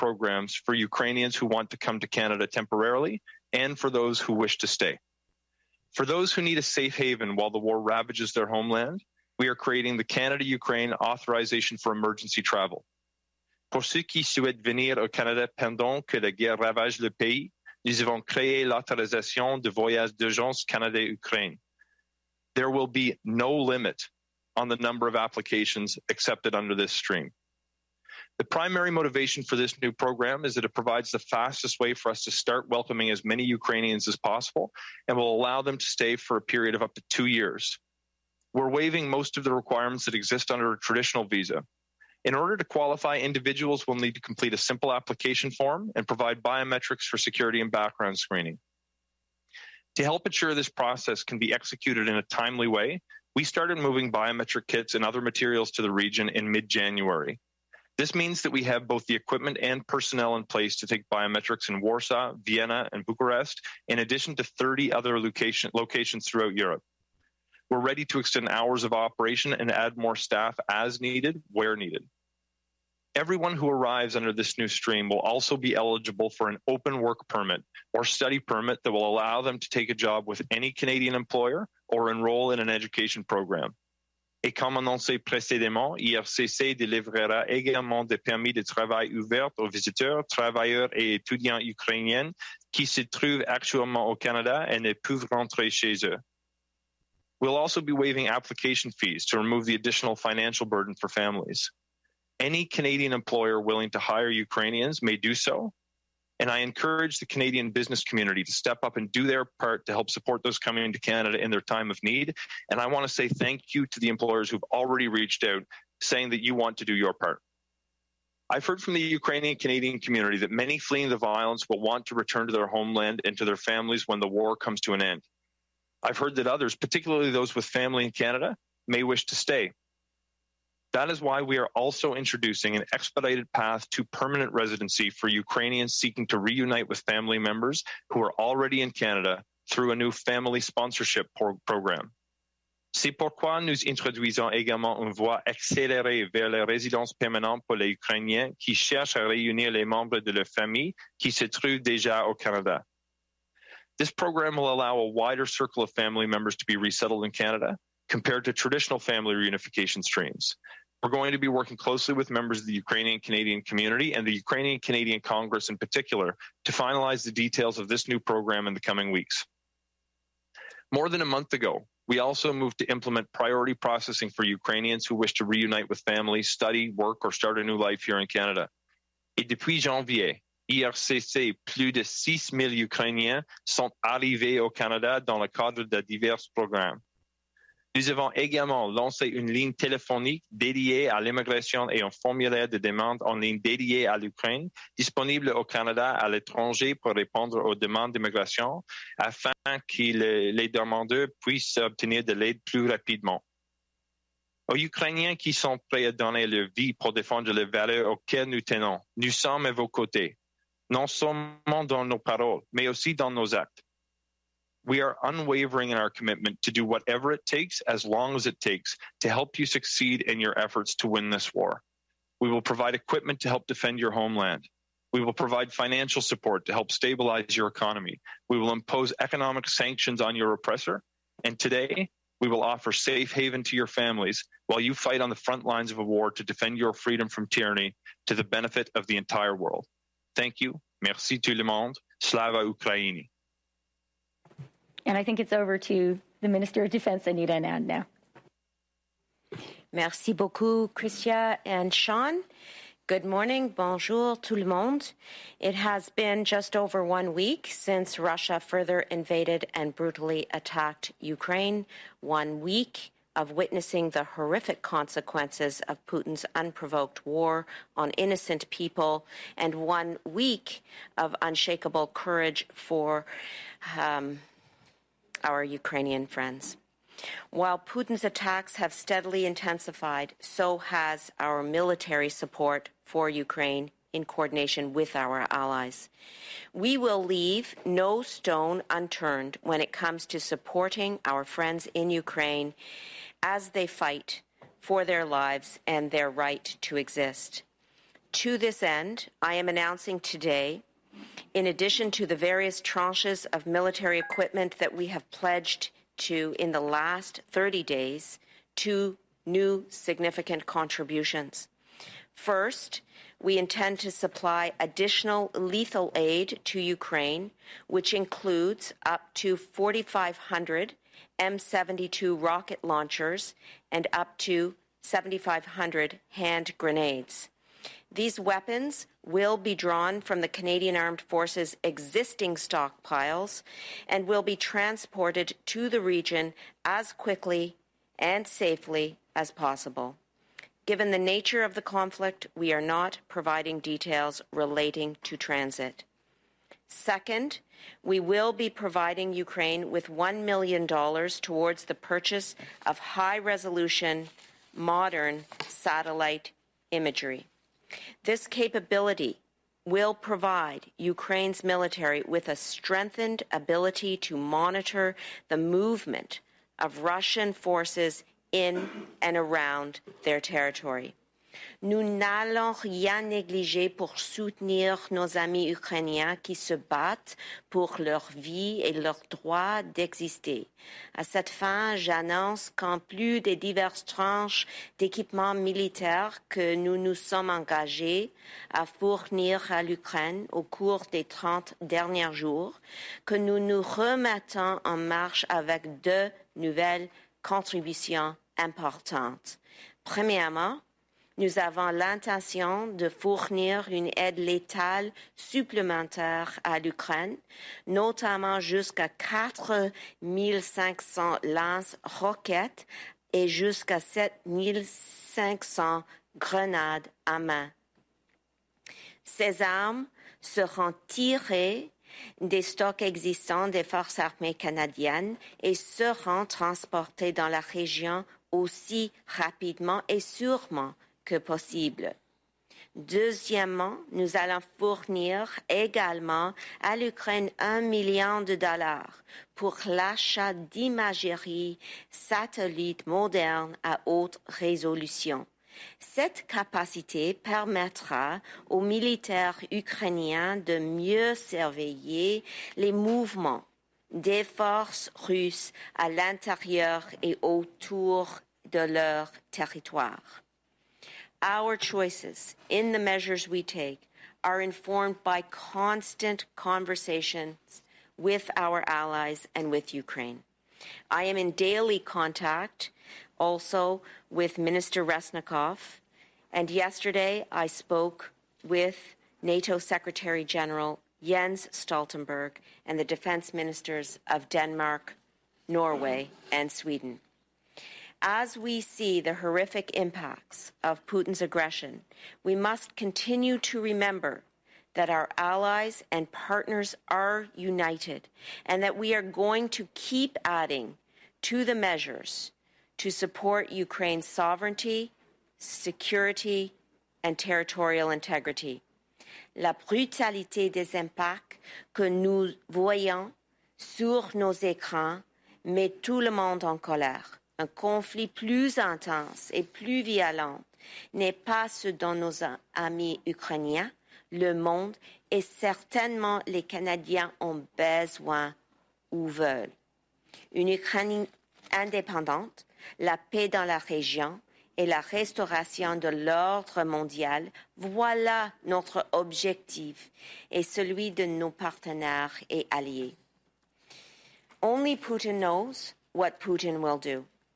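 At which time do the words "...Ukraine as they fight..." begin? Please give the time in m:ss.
4:52.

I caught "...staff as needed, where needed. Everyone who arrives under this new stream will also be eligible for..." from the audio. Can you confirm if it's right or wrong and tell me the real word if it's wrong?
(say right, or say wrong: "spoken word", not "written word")
right.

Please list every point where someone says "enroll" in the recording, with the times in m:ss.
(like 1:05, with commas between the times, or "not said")
1:22.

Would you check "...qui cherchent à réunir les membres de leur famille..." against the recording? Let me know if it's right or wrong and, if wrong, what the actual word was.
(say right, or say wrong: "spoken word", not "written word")
right.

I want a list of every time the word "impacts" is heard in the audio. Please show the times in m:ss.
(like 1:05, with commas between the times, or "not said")
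8:09, 8:30.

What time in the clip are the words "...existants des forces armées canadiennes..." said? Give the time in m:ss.
7:03.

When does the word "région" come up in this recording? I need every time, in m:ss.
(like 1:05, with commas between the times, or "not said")
7:07, 8:53.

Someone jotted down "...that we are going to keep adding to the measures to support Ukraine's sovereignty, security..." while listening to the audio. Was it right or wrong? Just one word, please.
right.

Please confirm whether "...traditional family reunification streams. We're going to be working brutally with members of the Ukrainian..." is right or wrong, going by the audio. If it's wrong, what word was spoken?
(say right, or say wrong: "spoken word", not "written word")
wrong: "closely", not "brutally".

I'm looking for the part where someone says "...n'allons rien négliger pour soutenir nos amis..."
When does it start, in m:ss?
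6:12.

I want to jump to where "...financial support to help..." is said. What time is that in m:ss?
3:45.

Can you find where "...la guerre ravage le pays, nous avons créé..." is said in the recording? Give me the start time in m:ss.
0:16.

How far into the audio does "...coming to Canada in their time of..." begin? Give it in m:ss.
1:50.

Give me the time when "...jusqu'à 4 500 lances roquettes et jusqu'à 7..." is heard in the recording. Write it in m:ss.
6:48.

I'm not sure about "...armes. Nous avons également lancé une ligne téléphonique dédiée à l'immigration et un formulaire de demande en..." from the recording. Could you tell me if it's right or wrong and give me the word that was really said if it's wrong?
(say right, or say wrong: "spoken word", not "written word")
wrong: "programmes", not "armes".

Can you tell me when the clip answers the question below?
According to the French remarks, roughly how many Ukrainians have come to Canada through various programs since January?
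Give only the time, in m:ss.
3:02.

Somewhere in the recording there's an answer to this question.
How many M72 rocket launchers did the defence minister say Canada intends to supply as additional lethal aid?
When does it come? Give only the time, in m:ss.
5:19.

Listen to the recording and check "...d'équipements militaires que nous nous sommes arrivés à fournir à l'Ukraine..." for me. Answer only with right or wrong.
wrong.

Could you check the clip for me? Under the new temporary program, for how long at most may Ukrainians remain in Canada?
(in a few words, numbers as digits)
up to two years.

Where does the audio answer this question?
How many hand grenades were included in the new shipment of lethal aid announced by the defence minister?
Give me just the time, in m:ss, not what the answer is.
5:25.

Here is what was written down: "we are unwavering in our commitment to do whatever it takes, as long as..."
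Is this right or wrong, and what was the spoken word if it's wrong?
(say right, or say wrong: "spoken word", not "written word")
right.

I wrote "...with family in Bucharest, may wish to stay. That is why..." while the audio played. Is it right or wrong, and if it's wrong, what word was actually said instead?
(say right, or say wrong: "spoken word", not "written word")
wrong: "Canada", not "Bucharest".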